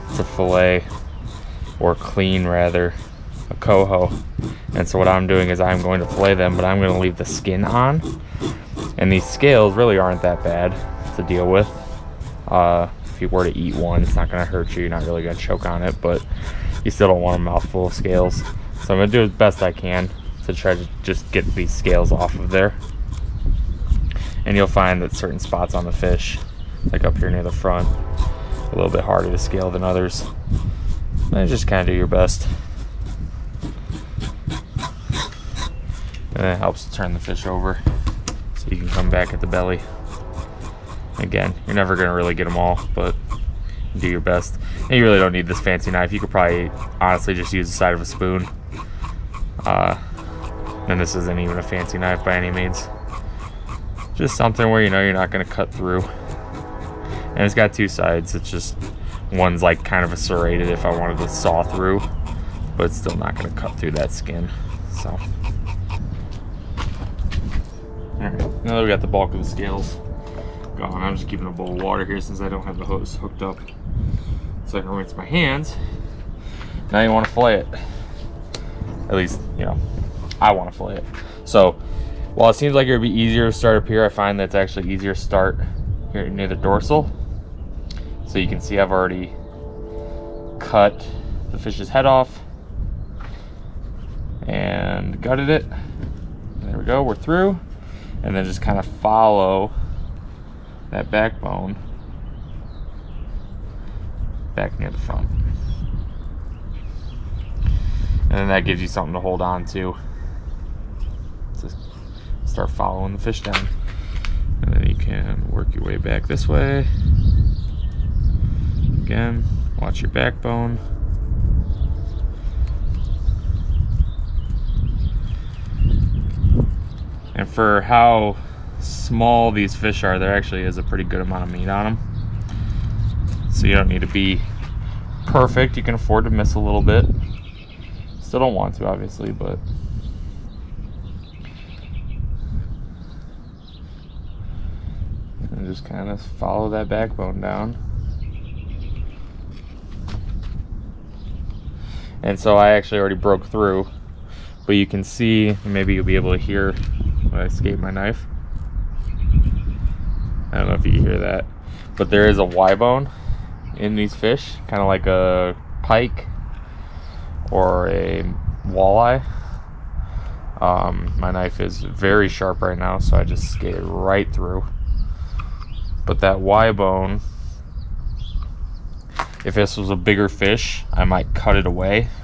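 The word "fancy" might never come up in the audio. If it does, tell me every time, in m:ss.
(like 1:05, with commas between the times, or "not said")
0:45, 0:51.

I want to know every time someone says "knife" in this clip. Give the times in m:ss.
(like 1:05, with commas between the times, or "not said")
0:45, 0:51, 2:37, 2:51.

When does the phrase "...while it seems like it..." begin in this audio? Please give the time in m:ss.
1:22.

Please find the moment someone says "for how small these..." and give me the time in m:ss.
2:07.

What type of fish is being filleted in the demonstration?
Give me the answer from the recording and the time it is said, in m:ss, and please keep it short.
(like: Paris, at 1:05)
coho, at 0:03.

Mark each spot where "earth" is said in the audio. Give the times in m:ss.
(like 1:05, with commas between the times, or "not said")
not said.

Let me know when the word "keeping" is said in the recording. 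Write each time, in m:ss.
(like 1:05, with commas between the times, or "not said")
1:11.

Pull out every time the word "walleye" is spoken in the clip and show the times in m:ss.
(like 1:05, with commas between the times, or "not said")
2:48.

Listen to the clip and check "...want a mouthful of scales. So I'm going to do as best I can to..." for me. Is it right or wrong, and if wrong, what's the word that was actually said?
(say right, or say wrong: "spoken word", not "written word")
right.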